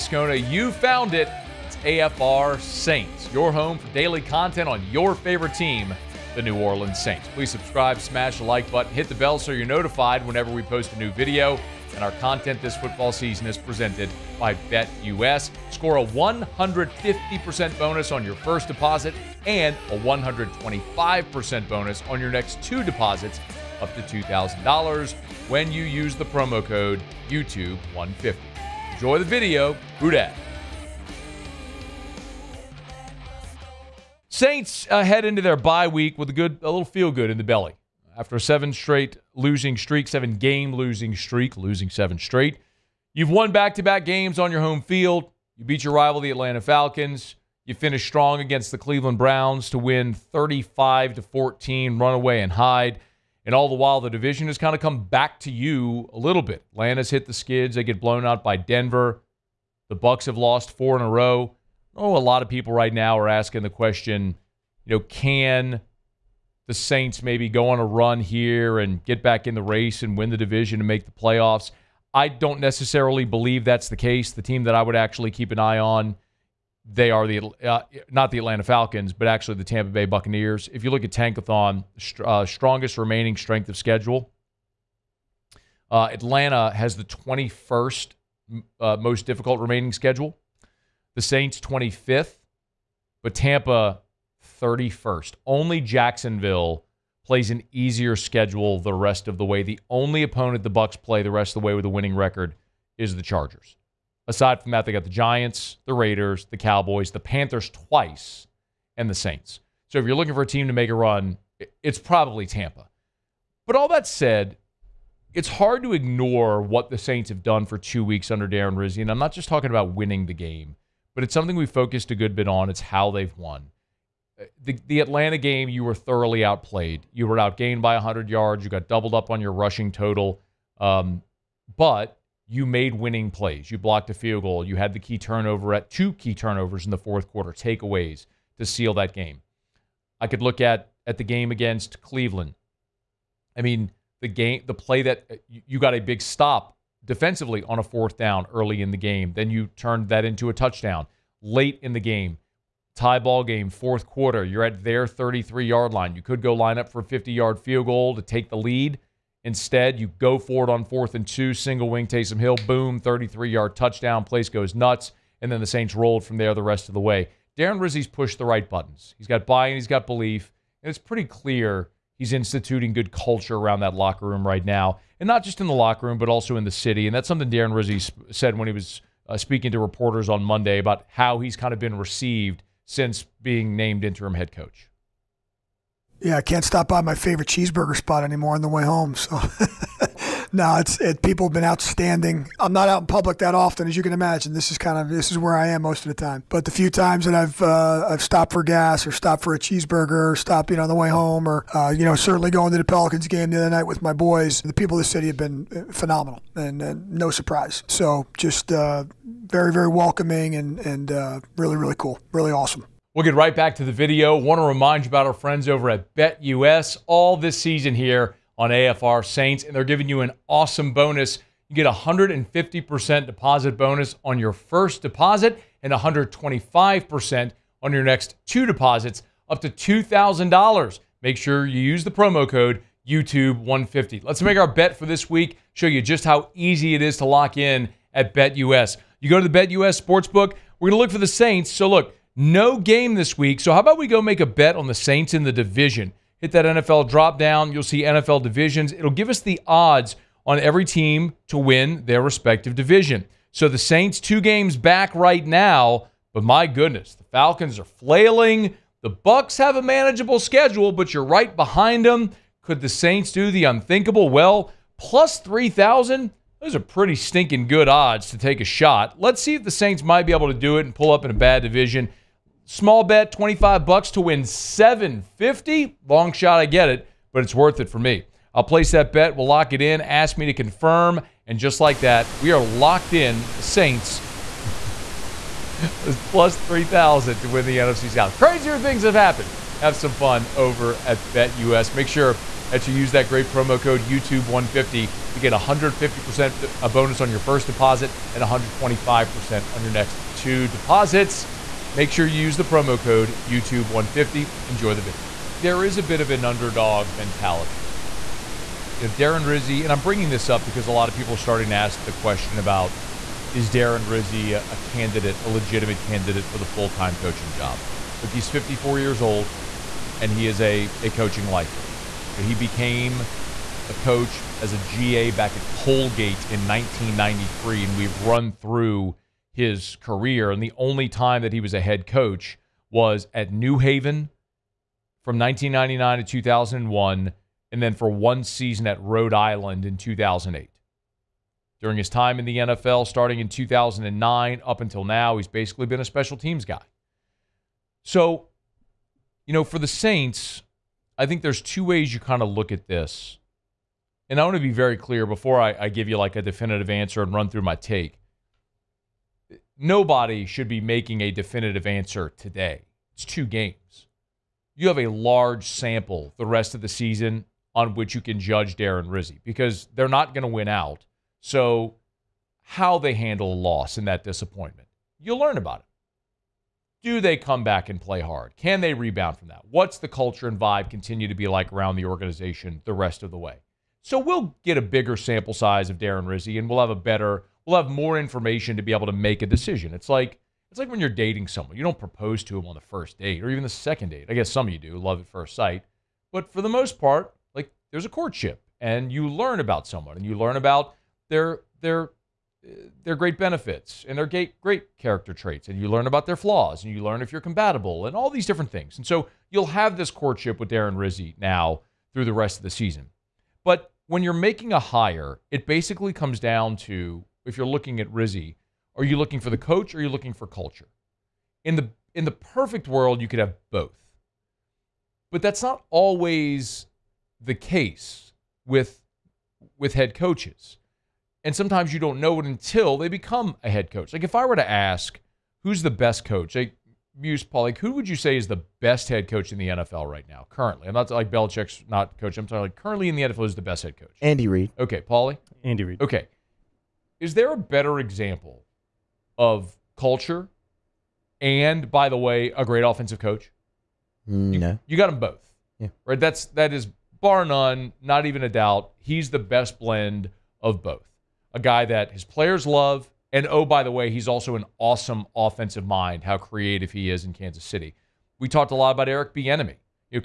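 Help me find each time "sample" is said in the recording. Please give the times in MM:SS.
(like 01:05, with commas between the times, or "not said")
06:05, 06:25.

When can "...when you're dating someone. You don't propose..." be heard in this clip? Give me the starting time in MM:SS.
06:30.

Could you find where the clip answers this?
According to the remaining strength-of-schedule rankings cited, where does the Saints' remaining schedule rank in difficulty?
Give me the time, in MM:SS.
01:31.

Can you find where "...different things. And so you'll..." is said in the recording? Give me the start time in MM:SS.
06:48.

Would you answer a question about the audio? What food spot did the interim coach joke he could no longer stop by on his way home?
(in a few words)
cheeseburger spot.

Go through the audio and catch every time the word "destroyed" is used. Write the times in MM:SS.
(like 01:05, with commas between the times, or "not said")
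not said.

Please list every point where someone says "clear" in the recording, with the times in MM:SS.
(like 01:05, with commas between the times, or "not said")
02:51, 05:54.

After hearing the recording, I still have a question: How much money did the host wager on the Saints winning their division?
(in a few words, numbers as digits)
$25.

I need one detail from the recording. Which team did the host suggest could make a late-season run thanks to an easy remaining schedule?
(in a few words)
Tampa Bay Buccaneers.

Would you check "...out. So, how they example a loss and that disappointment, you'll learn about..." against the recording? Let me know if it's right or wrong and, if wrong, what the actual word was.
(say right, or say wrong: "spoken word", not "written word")
wrong: "handle", not "example".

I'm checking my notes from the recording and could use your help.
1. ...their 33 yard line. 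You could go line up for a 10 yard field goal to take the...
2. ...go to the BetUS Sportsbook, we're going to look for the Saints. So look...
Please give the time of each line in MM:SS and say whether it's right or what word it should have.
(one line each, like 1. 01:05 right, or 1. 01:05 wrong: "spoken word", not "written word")
1. 02:34 wrong: "50", not "10"
2. 03:59 right.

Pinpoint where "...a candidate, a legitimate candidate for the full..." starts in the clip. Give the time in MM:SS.
05:14.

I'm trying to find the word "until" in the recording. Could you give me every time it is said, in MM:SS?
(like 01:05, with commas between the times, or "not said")
05:44, 07:12.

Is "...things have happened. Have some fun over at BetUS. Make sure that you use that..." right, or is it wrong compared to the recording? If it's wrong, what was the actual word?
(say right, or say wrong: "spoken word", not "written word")
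right.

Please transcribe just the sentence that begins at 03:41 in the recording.
You get 150% deposit bonus on your first deposit and 125% on your next two deposits, up to $2,000.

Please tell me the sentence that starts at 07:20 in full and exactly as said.
I'm not like Belichick's not coach.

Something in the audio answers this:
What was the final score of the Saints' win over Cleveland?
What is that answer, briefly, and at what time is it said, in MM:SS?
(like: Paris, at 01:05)
35 to 14, at 00:50.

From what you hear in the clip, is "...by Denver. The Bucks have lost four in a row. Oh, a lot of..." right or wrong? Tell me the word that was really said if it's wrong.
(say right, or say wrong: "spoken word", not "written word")
right.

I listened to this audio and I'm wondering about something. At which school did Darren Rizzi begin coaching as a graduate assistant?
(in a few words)
Colgate.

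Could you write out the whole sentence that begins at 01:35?
Only Jacksonville plays an easier schedule the rest of the way.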